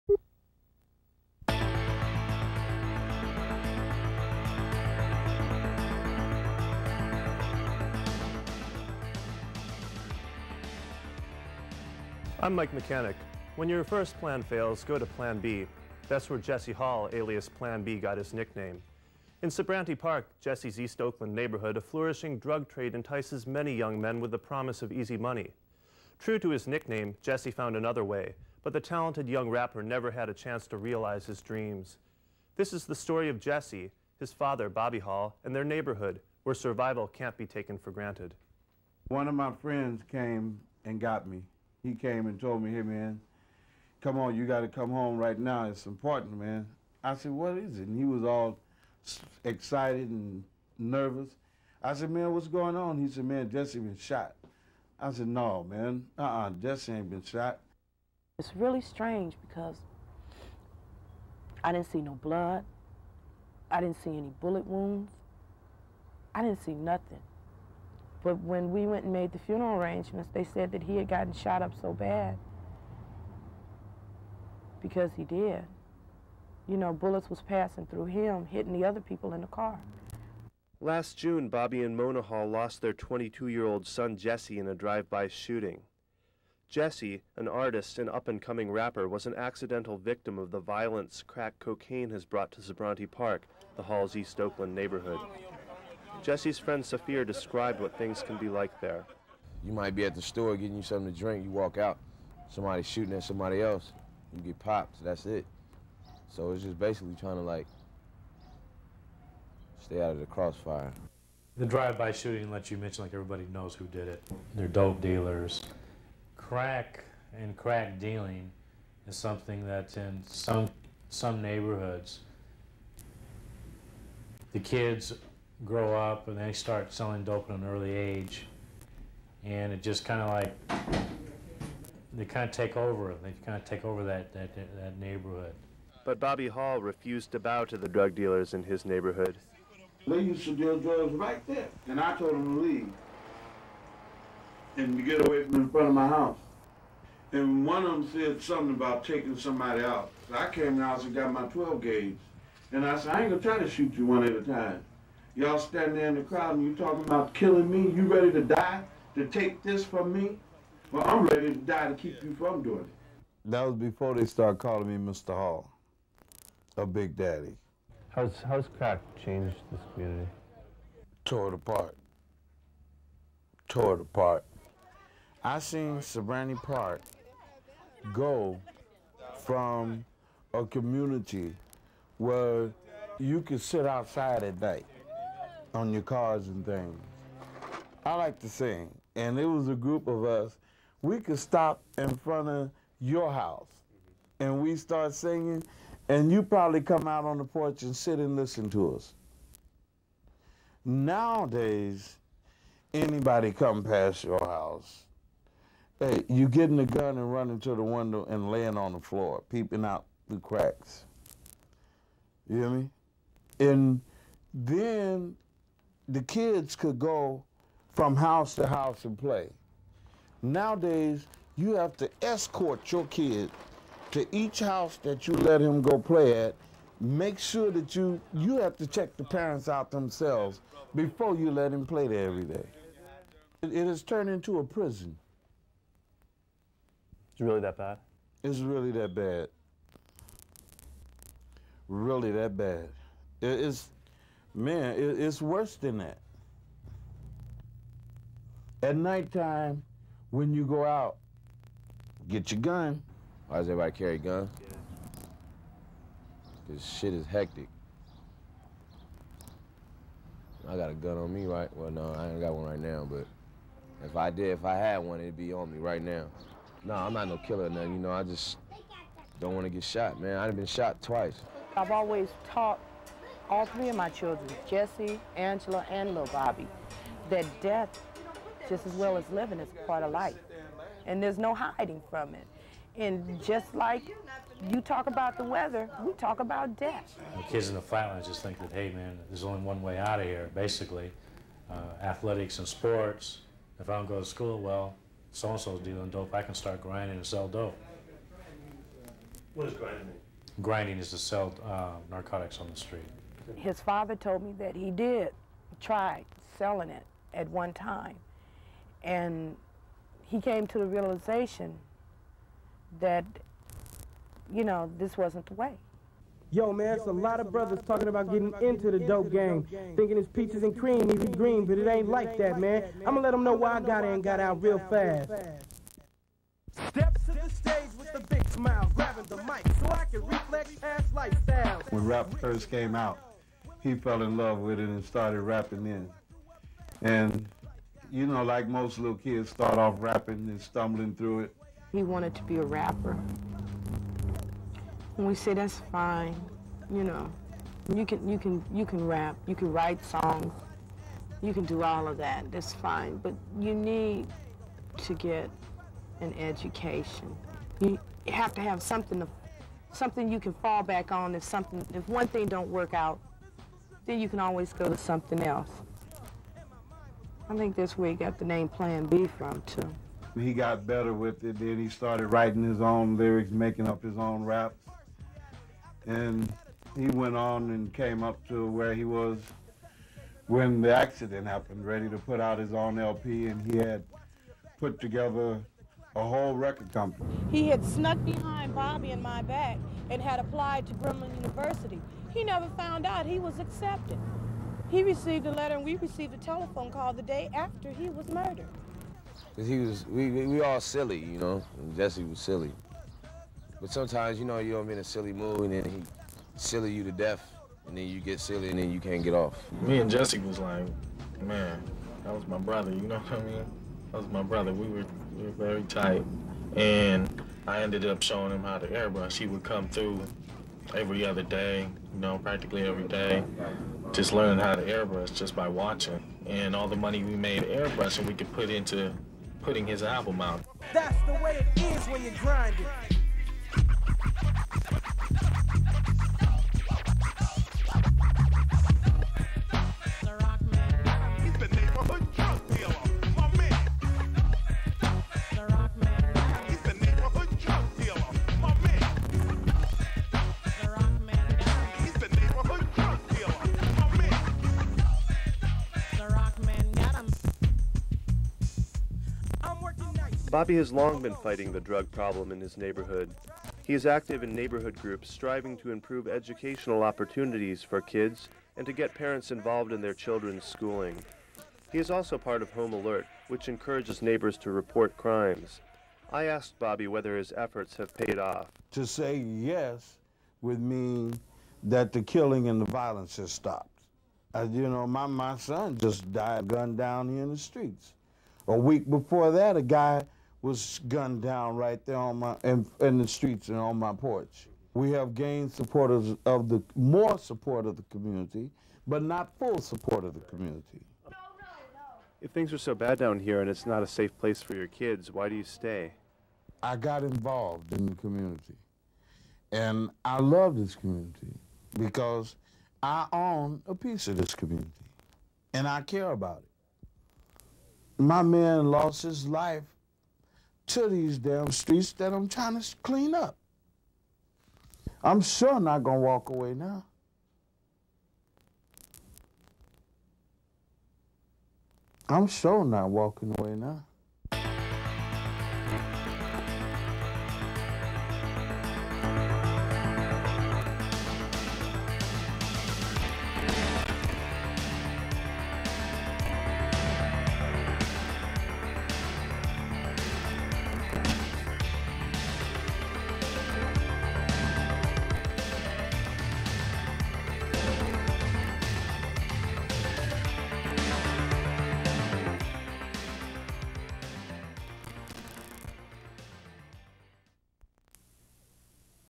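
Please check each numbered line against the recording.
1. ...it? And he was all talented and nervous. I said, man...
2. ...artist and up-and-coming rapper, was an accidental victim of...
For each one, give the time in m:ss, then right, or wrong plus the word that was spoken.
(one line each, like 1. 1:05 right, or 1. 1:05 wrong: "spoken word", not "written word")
1. 0:47 wrong: "excited", not "talented"
2. 1:27 right.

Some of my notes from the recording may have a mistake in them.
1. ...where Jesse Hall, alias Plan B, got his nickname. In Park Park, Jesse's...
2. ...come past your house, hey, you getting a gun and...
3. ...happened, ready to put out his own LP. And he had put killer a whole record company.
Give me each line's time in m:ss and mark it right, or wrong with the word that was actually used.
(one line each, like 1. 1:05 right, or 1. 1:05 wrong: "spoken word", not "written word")
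1. 0:16 wrong: "Sobrante", not "Park"
2. 3:23 right
3. 6:21 wrong: "together", not "killer".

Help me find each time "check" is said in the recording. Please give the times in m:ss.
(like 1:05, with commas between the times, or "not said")
3:48.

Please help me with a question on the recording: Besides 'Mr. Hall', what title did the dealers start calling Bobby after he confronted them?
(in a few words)
Big Daddy.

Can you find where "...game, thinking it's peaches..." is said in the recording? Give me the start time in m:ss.
5:19.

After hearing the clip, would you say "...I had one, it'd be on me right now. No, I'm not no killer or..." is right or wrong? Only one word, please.
right.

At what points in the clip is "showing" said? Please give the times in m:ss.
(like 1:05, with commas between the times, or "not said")
6:58.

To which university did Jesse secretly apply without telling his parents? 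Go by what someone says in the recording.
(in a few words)
Grambling University.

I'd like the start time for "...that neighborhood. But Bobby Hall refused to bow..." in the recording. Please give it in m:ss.
2:14.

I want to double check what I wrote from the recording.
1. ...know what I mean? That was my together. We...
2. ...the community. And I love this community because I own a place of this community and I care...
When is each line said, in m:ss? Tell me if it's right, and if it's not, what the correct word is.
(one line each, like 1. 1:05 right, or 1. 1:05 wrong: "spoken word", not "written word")
1. 6:52 wrong: "brother", not "together"
2. 8:28 wrong: "piece", not "place".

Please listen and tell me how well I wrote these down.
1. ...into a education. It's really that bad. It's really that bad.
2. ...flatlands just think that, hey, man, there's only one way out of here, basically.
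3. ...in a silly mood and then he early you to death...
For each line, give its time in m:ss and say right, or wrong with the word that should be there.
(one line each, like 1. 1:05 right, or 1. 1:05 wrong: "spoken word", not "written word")
1. 3:54 wrong: "prison", not "education"
2. 4:47 right
3. 6:44 wrong: "silly", not "early".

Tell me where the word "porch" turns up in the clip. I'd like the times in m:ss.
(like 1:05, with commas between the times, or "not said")
3:17, 8:14.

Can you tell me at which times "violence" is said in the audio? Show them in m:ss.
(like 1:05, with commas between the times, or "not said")
1:30, 8:02.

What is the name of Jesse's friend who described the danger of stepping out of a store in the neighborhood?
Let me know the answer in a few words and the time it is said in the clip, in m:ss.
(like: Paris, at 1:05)
Safir, at 1:36.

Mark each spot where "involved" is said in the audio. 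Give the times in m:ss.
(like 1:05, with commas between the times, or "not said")
7:49, 8:27.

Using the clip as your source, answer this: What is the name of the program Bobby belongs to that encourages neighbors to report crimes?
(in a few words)
Home Alert.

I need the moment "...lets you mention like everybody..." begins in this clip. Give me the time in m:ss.
1:52.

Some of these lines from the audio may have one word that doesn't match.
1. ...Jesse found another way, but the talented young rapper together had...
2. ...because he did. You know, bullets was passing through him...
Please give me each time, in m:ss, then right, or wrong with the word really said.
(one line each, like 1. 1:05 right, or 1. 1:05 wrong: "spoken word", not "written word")
1. 0:27 wrong: "never", not "together"
2. 1:14 right.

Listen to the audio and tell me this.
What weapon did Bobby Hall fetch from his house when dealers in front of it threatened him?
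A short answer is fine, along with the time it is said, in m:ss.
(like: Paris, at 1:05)
12 gauge, at 2:31.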